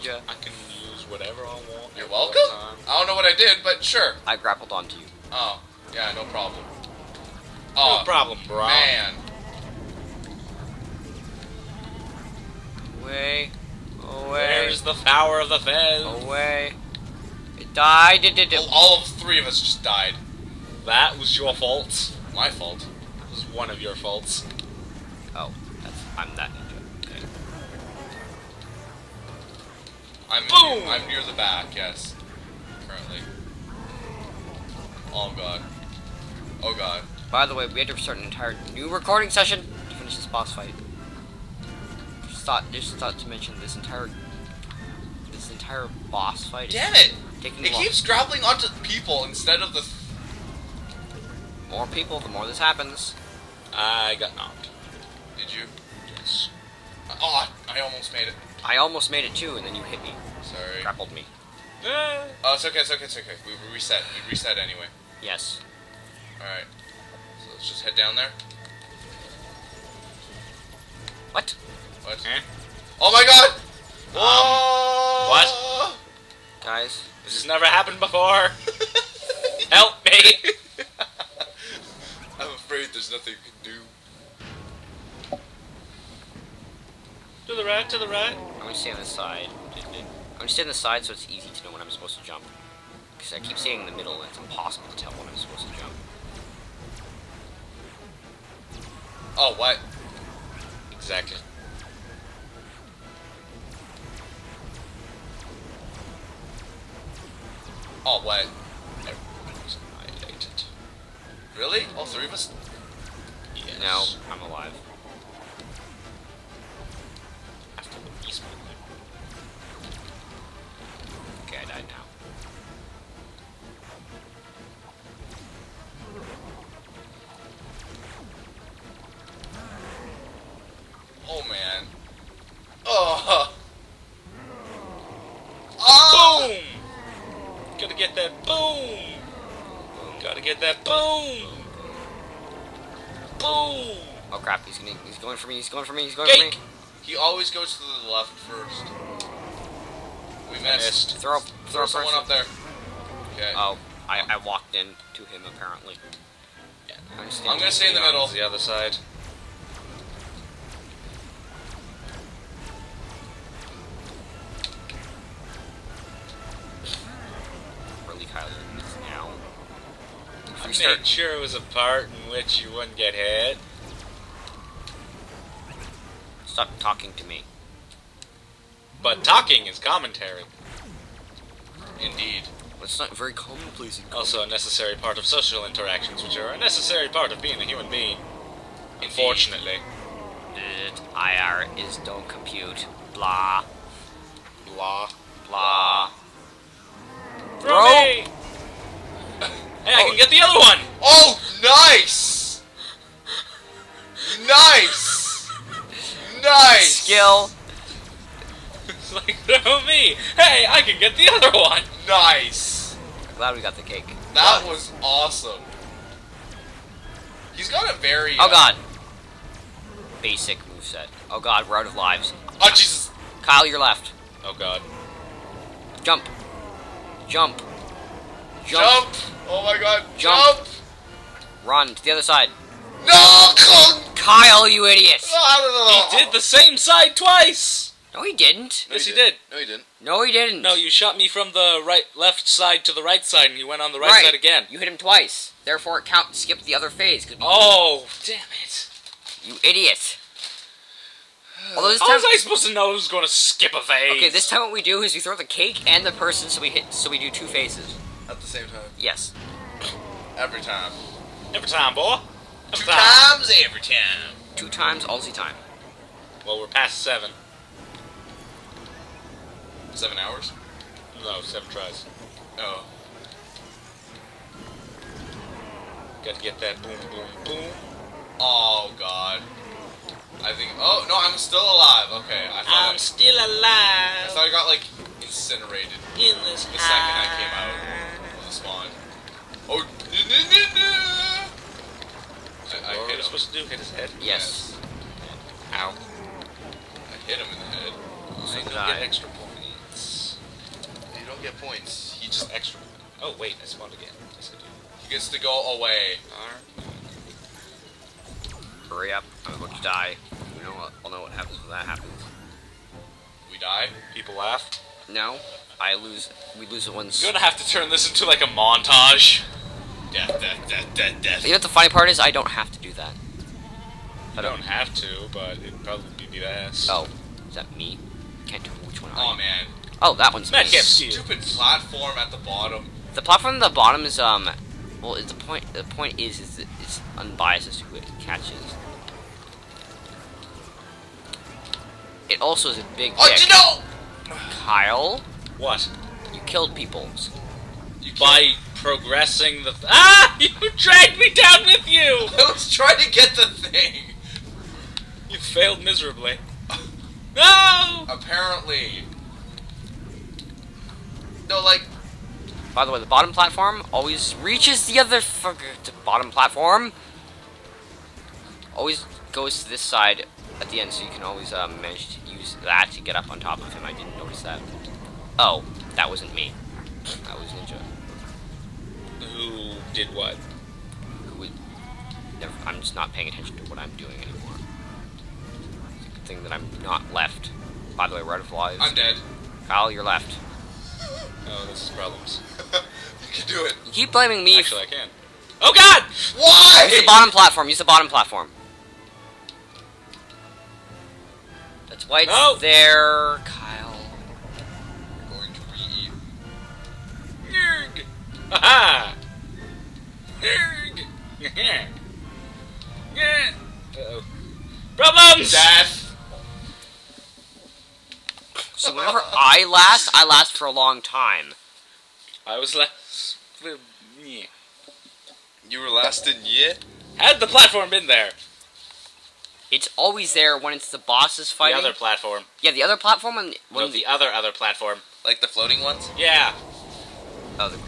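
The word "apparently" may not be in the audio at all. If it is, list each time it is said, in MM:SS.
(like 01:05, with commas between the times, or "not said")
02:35, 05:58.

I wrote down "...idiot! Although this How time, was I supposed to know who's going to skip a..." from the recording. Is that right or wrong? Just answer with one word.
right.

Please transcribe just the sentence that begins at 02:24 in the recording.
Oh crap, he's gonna he's going for me, he's going for me, he's going Gank.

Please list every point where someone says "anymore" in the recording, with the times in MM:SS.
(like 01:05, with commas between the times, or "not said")
06:24.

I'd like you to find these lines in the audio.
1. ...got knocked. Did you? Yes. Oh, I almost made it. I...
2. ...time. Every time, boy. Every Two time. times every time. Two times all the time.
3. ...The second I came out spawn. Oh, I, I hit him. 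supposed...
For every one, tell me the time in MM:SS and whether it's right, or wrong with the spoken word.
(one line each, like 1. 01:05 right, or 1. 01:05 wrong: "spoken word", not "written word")
1. 00:54 right
2. 04:20 right
3. 04:46 right.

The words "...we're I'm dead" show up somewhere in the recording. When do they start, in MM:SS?
06:28.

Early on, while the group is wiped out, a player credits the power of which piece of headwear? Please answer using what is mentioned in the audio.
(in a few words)
the Fez.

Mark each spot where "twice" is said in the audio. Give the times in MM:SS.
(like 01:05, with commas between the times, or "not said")
03:57, 04:04.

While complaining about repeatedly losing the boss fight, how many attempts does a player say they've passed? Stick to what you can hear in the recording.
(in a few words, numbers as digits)
7.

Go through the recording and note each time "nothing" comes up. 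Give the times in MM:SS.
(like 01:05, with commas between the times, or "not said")
01:23.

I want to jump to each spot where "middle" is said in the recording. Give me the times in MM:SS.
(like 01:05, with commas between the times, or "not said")
01:33, 02:38.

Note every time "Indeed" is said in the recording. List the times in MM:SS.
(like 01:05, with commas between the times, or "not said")
03:02, 03:08.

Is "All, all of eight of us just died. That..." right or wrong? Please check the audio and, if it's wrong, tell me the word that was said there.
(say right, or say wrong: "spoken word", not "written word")
wrong: "three", not "eight".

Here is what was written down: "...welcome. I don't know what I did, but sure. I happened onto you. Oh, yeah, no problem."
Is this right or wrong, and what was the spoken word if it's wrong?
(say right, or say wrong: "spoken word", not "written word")
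wrong: "grappled", not "happened".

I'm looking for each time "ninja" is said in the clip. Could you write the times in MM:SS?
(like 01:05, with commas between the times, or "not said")
00:26, 06:17.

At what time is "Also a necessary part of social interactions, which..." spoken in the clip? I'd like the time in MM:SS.
03:04.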